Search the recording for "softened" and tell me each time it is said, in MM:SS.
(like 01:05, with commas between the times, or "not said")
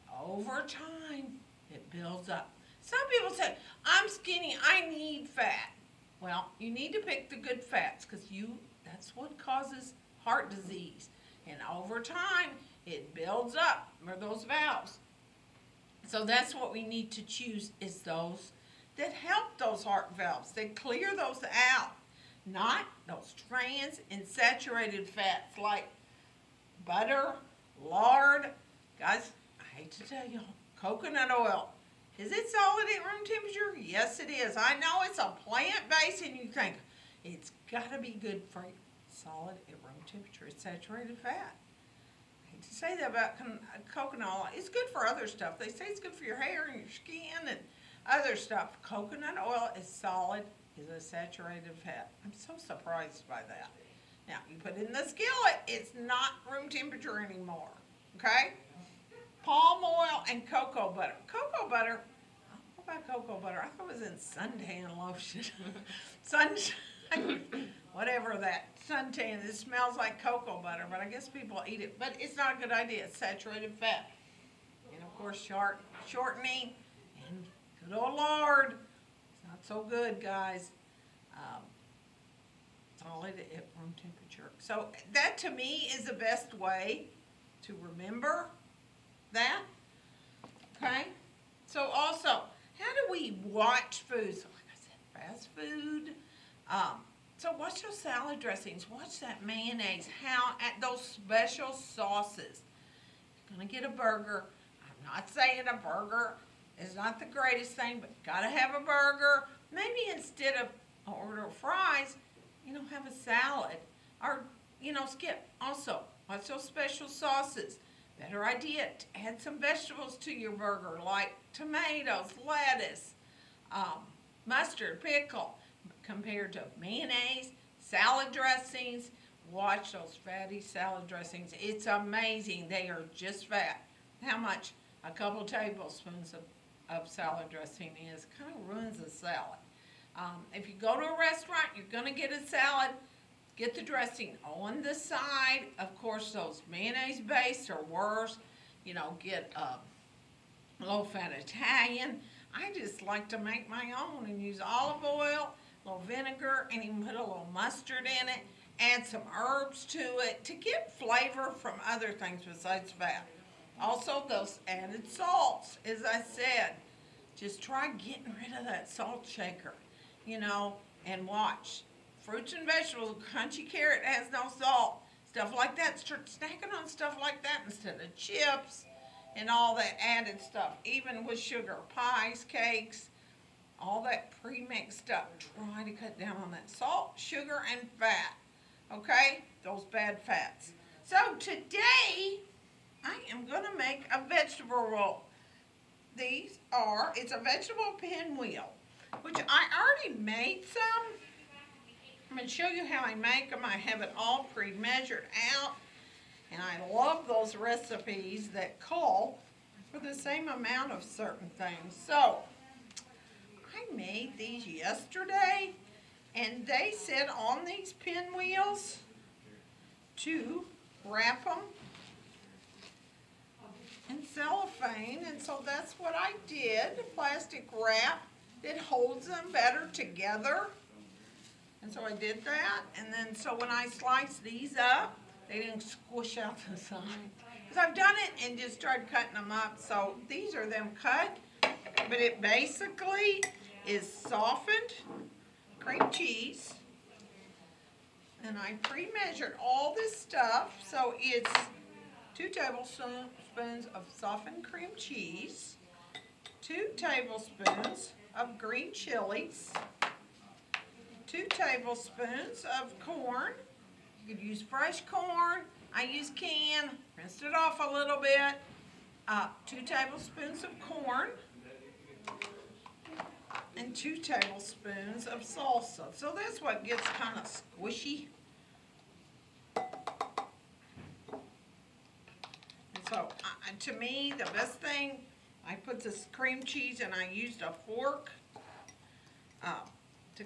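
04:04, 04:14.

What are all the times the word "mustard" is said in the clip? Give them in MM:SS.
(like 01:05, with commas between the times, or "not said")
02:04, 02:37.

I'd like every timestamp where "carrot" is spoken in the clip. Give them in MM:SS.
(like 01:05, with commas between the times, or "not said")
02:53.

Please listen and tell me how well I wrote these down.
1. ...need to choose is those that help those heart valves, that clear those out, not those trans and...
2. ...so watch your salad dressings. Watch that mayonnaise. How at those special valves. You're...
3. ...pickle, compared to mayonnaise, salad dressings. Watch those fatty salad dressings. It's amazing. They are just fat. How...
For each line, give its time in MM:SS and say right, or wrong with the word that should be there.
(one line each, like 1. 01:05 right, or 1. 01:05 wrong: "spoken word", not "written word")
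1. 00:16 right
2. 01:37 wrong: "sauces", not "valves"
3. 02:05 right.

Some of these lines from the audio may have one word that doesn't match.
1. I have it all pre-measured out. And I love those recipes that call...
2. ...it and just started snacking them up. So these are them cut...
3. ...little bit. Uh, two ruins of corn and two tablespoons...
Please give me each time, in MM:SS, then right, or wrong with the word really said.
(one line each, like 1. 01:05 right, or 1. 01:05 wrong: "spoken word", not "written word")
1. 03:23 right
2. 03:58 wrong: "cutting", not "snacking"
3. 04:27 wrong: "tablespoons", not "ruins".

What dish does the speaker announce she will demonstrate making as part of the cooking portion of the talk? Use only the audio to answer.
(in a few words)
vegetable pinwheel.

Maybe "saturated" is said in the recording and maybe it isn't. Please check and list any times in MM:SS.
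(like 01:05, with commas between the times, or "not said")
00:24, 00:40, 00:50, 01:13.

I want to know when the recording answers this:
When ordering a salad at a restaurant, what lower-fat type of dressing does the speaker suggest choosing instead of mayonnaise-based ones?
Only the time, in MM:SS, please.
02:30.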